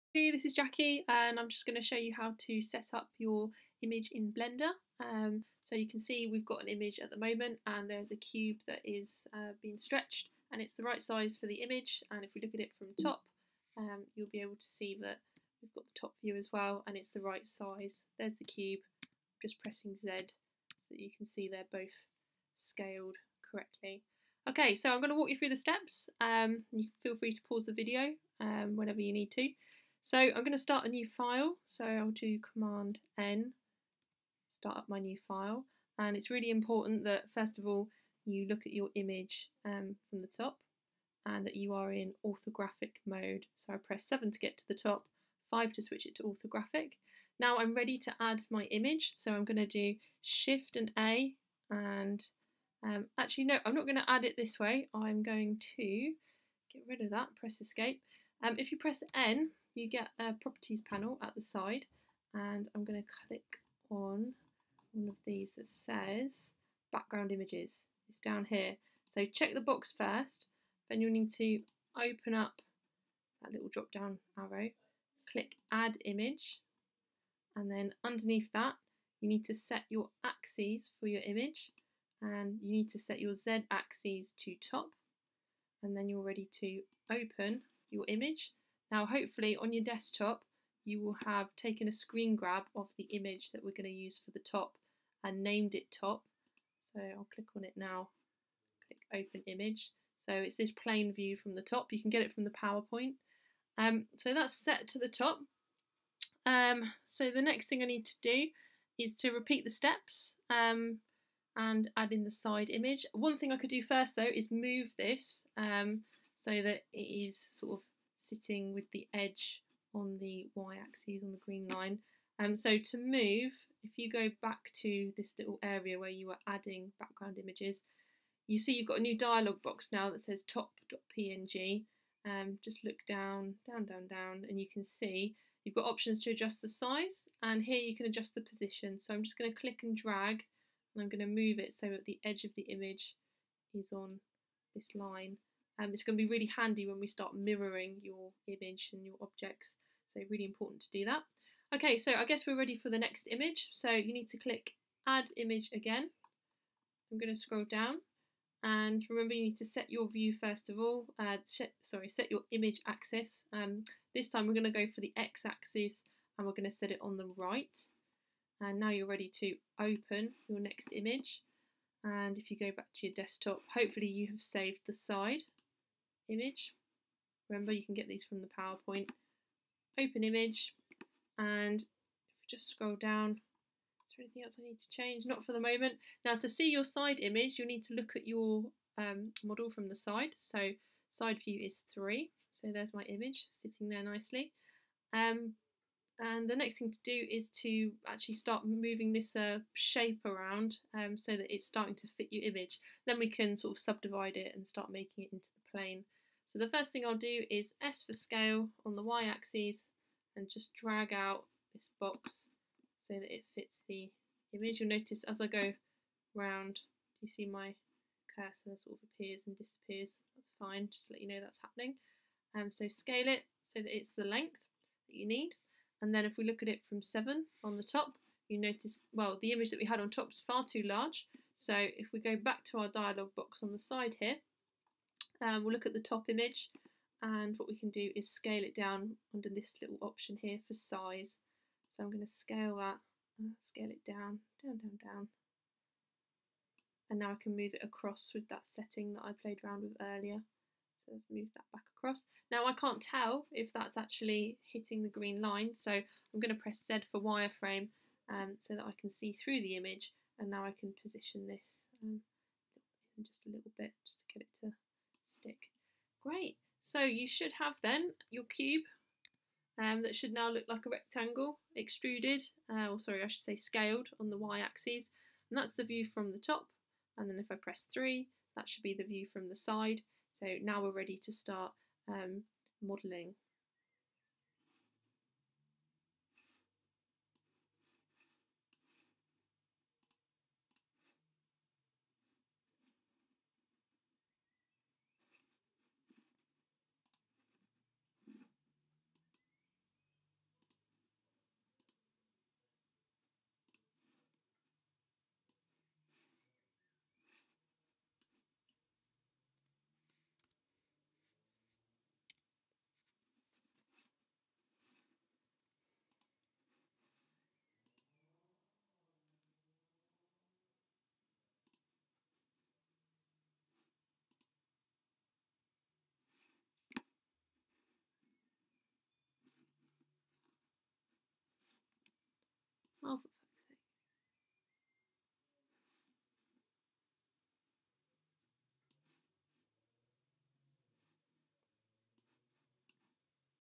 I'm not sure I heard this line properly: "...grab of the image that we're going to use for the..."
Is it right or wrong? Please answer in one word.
right.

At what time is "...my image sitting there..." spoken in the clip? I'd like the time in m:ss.
3:12.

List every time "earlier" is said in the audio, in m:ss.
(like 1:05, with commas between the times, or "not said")
4:10.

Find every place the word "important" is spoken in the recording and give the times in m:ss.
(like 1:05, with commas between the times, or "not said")
0:36, 2:30.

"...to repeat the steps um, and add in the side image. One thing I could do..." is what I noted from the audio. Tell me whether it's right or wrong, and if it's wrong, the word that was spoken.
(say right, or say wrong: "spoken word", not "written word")
right.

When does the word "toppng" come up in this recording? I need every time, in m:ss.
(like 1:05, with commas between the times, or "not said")
2:10.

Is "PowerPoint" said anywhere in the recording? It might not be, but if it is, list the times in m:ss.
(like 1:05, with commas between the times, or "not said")
1:42, 2:58.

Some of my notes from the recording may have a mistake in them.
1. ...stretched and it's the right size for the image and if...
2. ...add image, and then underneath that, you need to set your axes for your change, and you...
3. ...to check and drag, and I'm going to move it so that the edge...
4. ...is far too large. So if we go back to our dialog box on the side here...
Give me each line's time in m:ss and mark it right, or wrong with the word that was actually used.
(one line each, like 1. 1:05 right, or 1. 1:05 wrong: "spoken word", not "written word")
1. 0:09 right
2. 1:15 wrong: "image", not "change"
3. 2:19 wrong: "click", not "check"
4. 3:50 right.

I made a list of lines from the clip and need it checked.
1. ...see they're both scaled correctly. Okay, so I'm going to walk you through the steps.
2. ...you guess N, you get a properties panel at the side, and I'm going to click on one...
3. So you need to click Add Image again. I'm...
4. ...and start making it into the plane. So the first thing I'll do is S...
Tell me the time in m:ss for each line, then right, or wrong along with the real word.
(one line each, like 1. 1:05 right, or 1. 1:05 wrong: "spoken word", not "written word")
1. 0:21 right
2. 0:58 wrong: "press", not "guess"
3. 2:33 right
4. 3:24 right.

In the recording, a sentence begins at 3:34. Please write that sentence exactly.
You'll notice as I go round, do you see my cursor sort of appears and disappears?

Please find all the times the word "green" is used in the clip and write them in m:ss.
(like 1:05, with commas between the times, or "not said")
2:01, 4:15.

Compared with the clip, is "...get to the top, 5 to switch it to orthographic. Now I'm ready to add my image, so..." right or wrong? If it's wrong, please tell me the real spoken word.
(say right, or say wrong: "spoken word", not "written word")
right.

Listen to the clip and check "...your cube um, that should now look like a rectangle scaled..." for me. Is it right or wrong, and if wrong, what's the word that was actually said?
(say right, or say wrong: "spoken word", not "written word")
wrong: "extruded", not "scaled".